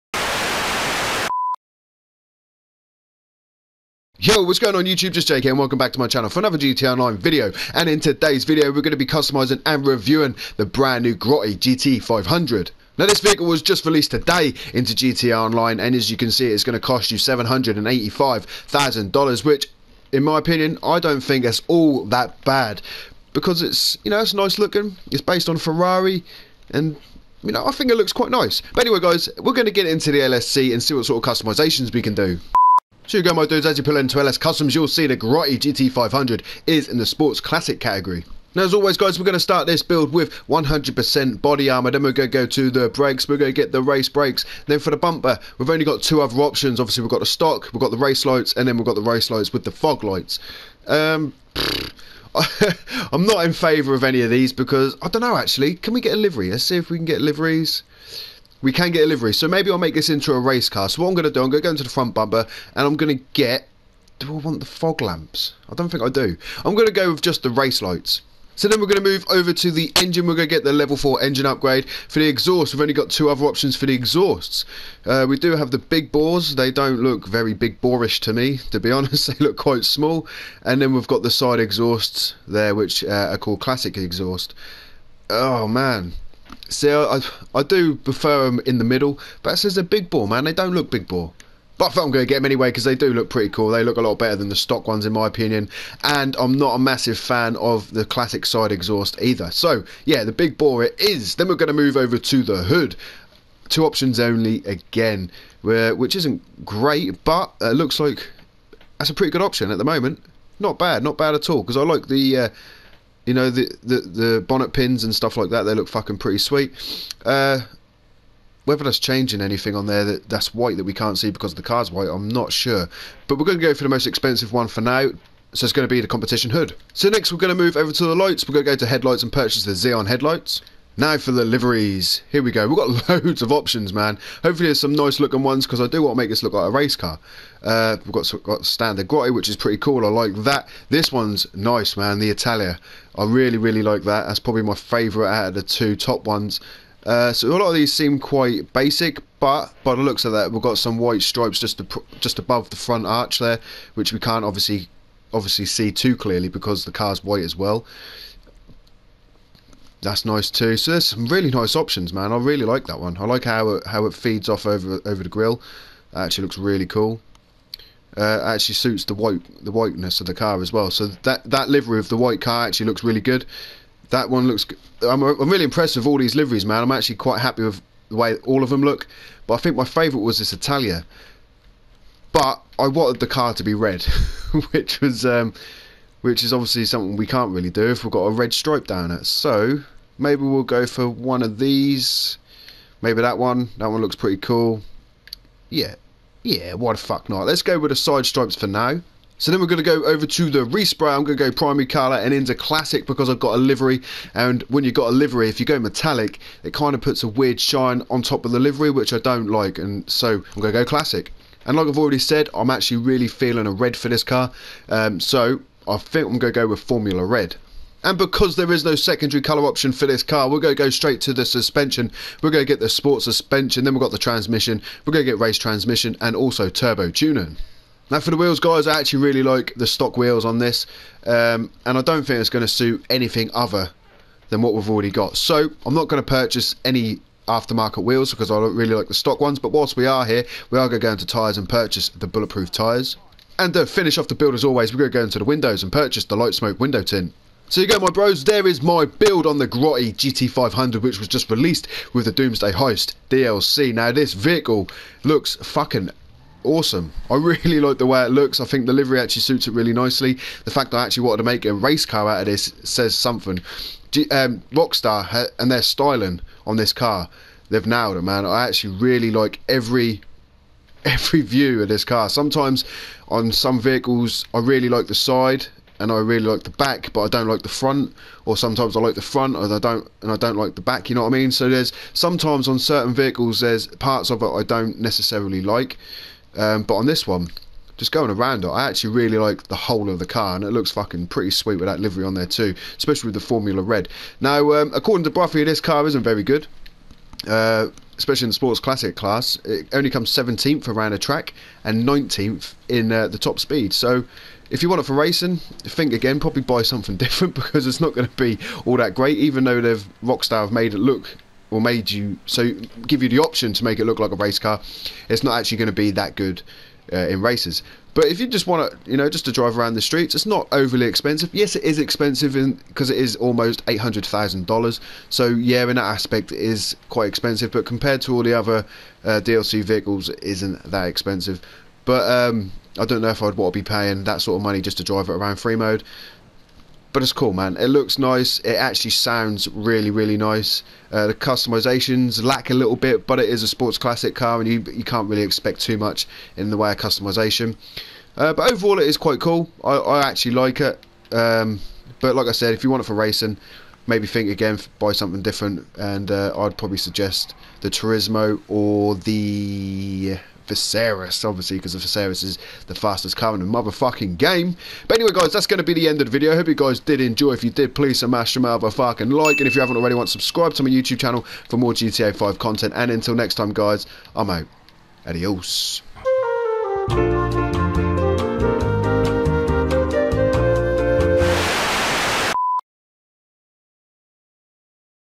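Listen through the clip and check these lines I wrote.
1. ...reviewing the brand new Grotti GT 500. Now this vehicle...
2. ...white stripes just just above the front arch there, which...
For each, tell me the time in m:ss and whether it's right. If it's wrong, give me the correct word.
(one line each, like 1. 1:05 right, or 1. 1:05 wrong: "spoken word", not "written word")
1. 0:09 right
2. 2:30 right.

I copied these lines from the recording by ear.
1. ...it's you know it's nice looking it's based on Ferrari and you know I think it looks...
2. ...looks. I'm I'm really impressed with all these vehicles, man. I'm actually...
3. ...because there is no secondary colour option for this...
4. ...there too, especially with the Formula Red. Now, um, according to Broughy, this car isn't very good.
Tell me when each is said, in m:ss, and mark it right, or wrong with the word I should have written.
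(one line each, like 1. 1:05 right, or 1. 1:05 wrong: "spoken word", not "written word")
1. 0:23 right
2. 2:54 wrong: "liveries", not "vehicles"
3. 3:38 right
4. 4:52 right.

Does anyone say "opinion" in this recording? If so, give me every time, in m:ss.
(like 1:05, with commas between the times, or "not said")
0:20, 1:35.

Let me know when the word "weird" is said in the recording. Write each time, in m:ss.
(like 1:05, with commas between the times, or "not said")
3:27.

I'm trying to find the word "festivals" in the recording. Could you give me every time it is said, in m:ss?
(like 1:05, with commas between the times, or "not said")
not said.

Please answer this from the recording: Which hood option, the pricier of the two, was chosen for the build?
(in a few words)
competition hood.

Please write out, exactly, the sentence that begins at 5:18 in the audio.
But if you just want to, you know, just to drive around the streets, it's not overly expensive.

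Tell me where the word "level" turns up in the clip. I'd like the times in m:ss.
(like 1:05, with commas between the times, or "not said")
1:10.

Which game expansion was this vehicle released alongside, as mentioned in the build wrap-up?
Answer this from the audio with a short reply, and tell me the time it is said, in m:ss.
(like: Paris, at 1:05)
Doomsday Heist, at 4:12.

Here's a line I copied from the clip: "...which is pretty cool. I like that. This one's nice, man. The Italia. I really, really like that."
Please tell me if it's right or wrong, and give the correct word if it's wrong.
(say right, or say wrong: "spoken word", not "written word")
right.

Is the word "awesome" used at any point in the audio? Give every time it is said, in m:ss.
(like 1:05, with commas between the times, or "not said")
4:16.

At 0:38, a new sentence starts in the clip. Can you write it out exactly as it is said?
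Now, as always, guys, we're going to start this build with 100% body armor.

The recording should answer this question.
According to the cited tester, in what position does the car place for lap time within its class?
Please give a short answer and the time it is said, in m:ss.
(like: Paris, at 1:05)
17th, at 5:00.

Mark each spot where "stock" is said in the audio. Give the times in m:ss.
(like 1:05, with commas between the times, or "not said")
0:47, 1:34, 3:49, 3:59.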